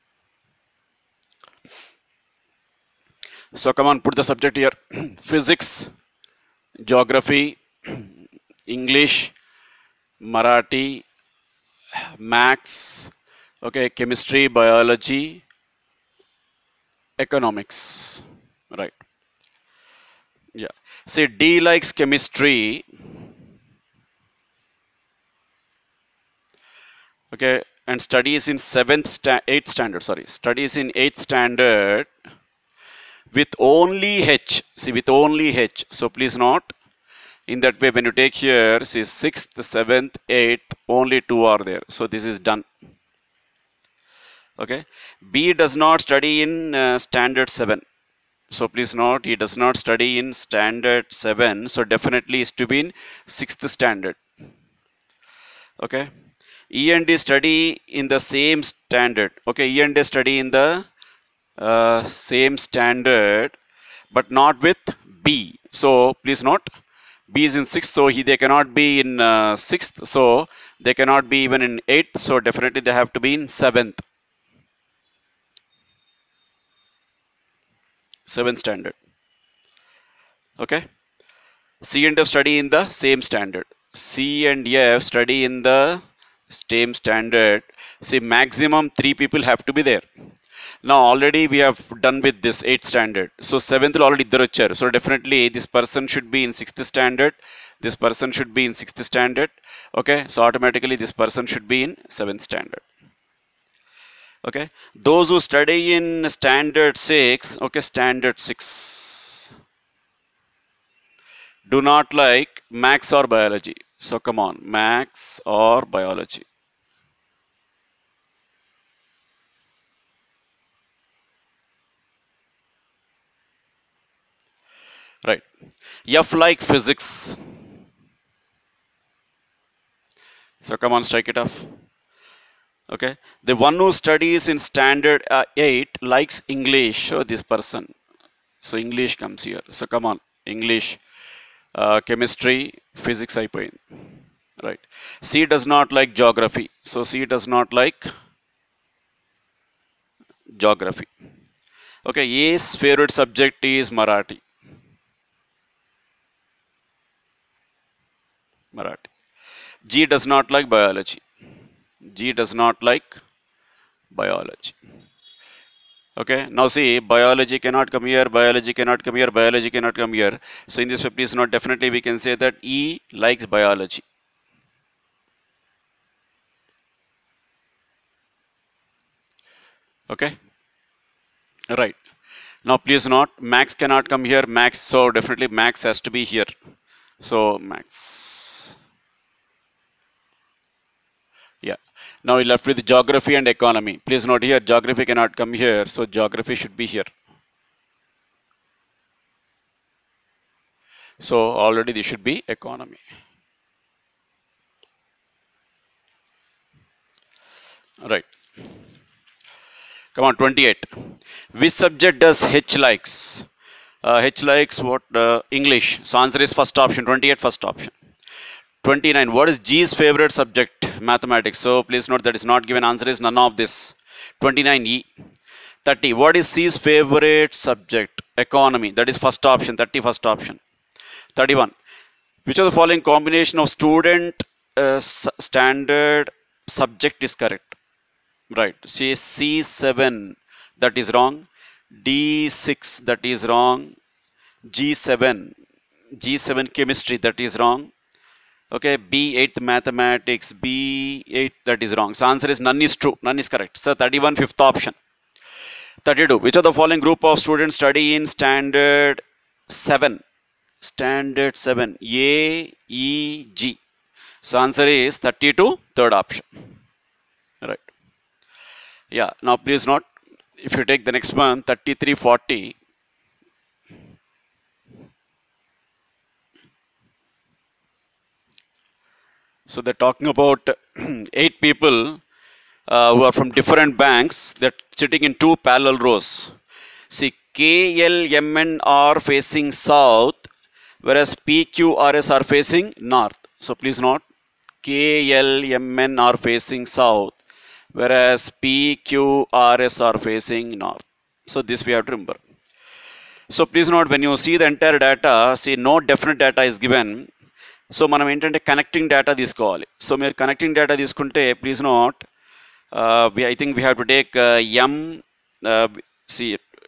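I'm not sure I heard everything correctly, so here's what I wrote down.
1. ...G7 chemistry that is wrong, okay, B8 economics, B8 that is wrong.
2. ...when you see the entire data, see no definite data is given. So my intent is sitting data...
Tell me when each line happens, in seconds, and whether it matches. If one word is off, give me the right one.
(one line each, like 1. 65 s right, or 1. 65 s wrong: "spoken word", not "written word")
1. 246 s wrong: "mathematics", not "economics"
2. 304 s wrong: "connecting", not "sitting".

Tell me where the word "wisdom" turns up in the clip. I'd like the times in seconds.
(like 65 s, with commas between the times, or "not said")
not said.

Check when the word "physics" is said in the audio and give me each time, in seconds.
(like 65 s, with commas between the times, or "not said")
5 s, 126 s, 142 s.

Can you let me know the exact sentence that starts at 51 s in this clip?
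So definitely is to be in 6th standard.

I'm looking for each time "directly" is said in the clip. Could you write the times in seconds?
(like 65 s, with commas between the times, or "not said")
not said.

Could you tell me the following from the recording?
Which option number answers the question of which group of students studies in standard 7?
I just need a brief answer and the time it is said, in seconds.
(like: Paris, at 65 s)
Third option, at 265 s.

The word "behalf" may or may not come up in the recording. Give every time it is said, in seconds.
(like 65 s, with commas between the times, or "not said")
not said.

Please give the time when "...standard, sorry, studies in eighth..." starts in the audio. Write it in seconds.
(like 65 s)
29 s.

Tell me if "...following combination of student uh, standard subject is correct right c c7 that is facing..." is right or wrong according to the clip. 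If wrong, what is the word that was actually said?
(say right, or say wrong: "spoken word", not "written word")
wrong: "wrong", not "facing".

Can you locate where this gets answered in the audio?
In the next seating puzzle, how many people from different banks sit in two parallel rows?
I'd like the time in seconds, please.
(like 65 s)
281 s.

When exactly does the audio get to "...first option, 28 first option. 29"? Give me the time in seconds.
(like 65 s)
216 s.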